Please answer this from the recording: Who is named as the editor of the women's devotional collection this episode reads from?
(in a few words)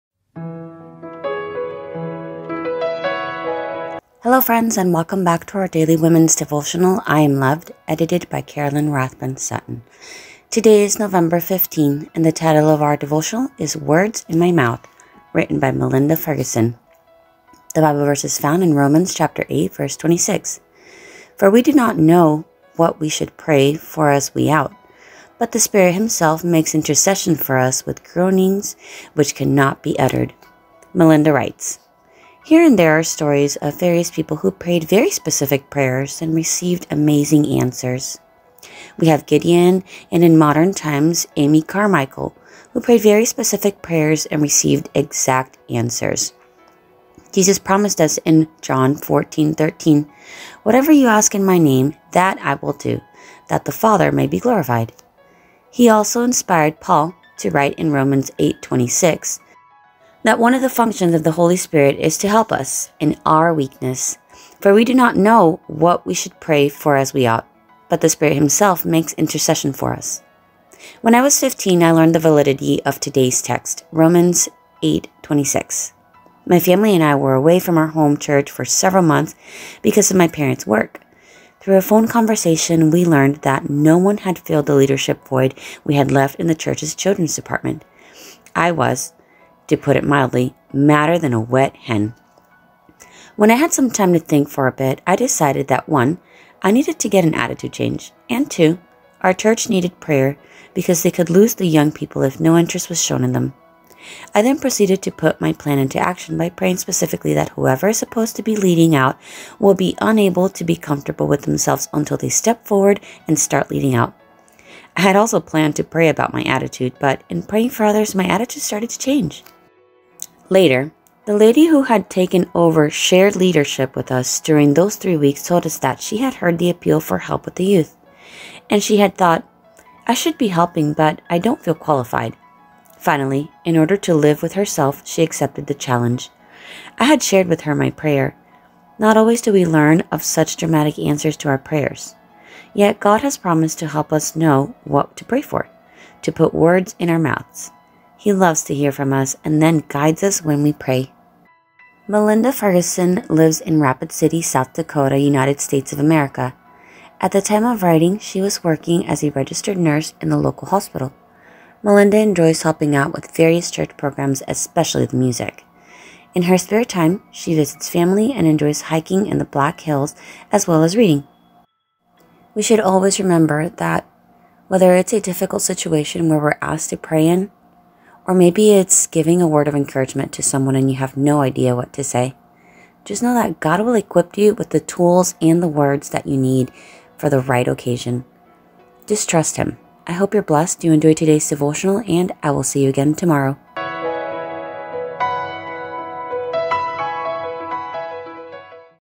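Carolyn Rathbun Sutton.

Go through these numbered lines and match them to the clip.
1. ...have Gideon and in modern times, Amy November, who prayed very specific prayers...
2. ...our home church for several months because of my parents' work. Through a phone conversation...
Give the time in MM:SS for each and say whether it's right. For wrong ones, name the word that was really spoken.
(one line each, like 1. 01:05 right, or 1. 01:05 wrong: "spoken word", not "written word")
1. 00:39 wrong: "Carmichael", not "November"
2. 01:17 right.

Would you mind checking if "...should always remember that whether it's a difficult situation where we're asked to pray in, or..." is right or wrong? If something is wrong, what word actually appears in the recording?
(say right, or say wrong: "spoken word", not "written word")
right.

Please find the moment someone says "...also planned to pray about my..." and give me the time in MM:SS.
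01:55.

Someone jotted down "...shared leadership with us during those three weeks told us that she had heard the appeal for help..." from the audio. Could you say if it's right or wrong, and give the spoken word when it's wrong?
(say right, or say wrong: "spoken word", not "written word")
right.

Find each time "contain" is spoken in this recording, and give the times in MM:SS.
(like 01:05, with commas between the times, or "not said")
not said.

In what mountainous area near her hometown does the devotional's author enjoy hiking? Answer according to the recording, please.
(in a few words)
Black Hills.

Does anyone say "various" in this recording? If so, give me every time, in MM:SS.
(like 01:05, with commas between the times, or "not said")
00:33, 02:43.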